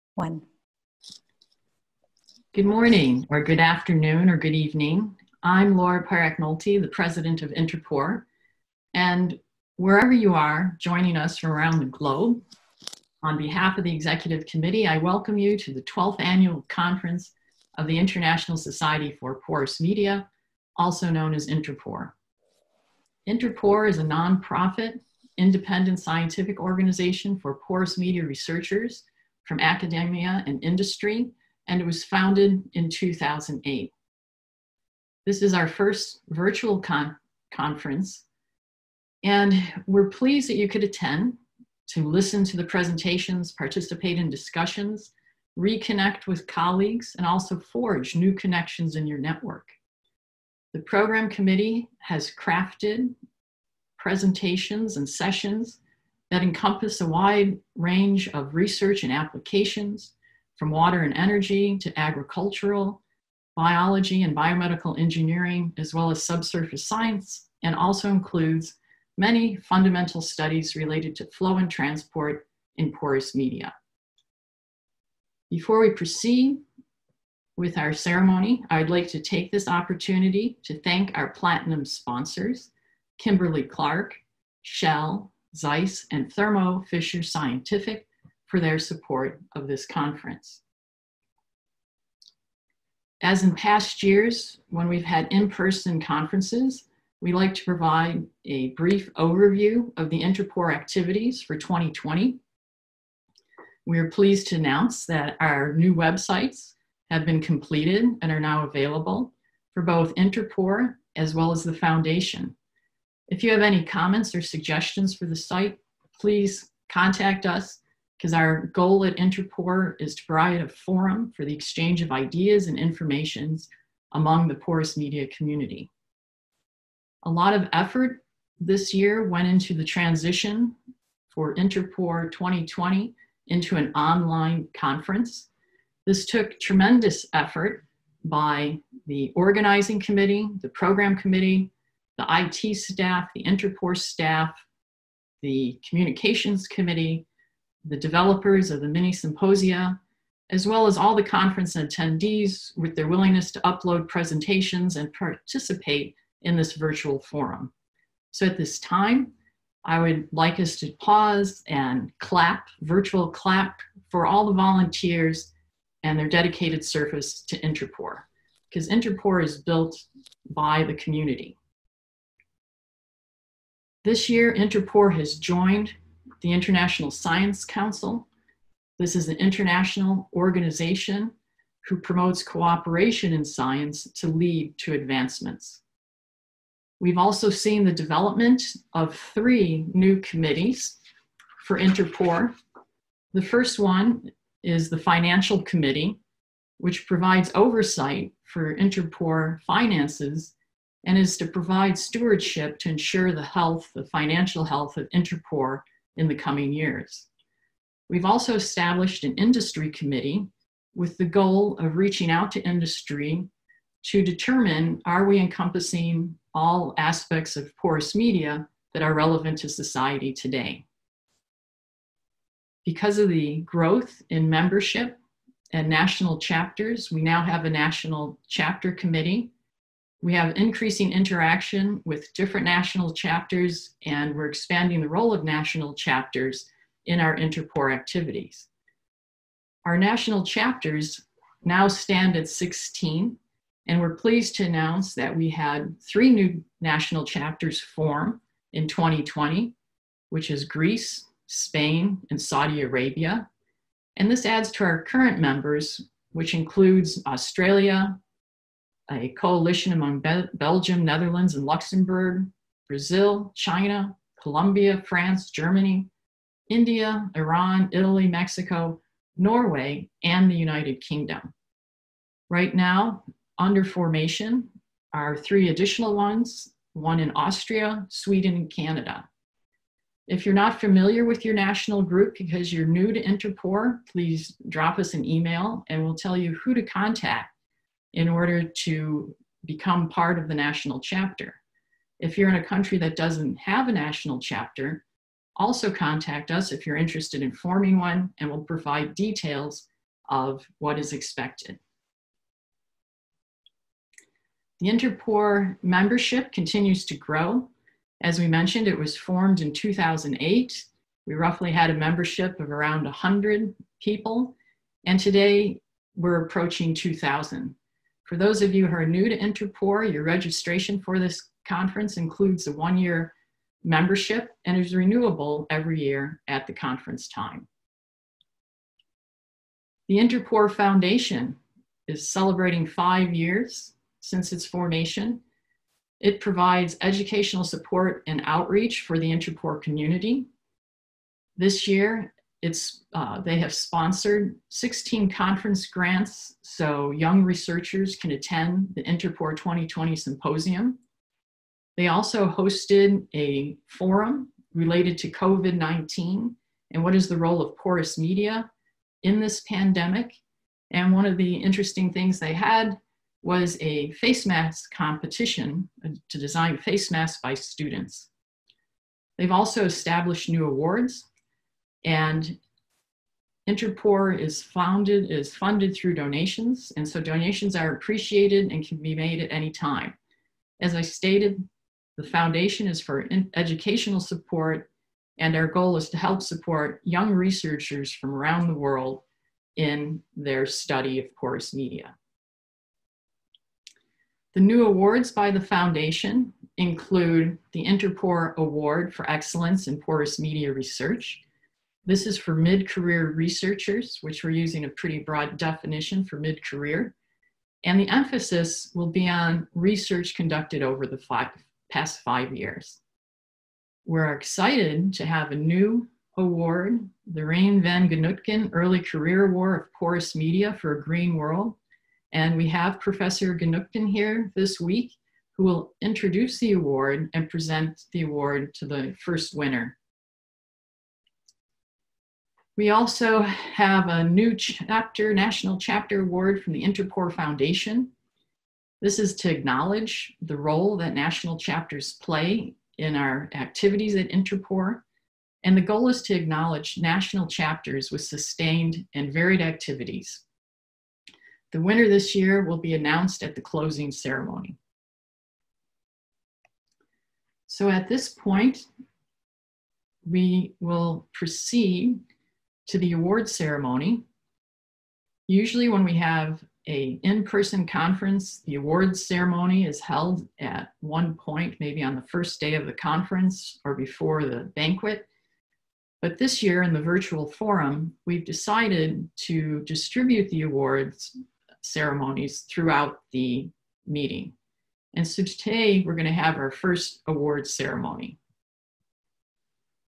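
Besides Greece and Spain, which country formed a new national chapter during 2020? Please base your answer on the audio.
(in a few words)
Saudi Arabia.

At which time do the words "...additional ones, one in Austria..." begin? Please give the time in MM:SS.
04:35.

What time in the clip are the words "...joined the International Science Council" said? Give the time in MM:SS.
02:55.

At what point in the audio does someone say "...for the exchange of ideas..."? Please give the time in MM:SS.
02:01.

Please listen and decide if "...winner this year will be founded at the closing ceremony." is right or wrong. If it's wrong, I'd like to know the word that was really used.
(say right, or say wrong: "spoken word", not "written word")
wrong: "announced", not "founded".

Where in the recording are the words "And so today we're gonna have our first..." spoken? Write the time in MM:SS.
08:05.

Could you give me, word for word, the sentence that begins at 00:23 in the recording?
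InterPore is a nonprofit, independent scientific organization for porous media researchers from academia and industry, and it was founded in 2008.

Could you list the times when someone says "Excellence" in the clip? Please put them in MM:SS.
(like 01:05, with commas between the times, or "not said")
06:39.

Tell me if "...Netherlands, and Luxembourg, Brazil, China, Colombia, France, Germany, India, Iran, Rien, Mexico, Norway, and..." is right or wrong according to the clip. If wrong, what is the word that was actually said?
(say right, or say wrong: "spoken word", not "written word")
wrong: "Italy", not "Rien".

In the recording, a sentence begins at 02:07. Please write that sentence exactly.
A lot of effort this year went into the transition for InterPore 2020 into an online conference.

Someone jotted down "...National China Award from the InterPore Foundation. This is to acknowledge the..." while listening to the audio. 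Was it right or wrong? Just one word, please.
wrong.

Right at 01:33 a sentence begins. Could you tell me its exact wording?
As in past years, when we've had in-person conferences, we like to provide a brief overview of the InterPore activities for 2020.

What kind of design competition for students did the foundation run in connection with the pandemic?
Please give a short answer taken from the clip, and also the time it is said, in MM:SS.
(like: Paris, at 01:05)
face mask competition, at 06:04.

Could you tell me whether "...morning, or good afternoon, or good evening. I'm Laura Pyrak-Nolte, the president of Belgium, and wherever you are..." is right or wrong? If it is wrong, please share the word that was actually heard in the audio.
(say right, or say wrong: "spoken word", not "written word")
wrong: "InterPore", not "Belgium".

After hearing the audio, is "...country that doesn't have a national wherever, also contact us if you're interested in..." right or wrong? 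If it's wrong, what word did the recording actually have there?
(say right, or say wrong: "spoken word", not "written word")
wrong: "chapter", not "wherever".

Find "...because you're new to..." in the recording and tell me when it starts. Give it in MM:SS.
04:42.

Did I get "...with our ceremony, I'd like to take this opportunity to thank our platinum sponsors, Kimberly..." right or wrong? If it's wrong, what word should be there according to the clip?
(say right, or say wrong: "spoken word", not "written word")
right.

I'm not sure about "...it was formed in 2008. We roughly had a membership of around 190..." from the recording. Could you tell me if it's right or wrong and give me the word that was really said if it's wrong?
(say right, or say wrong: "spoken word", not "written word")
wrong: "100", not "190".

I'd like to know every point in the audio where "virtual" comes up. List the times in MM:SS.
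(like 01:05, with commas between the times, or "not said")
00:36, 02:36, 02:42, 07:57.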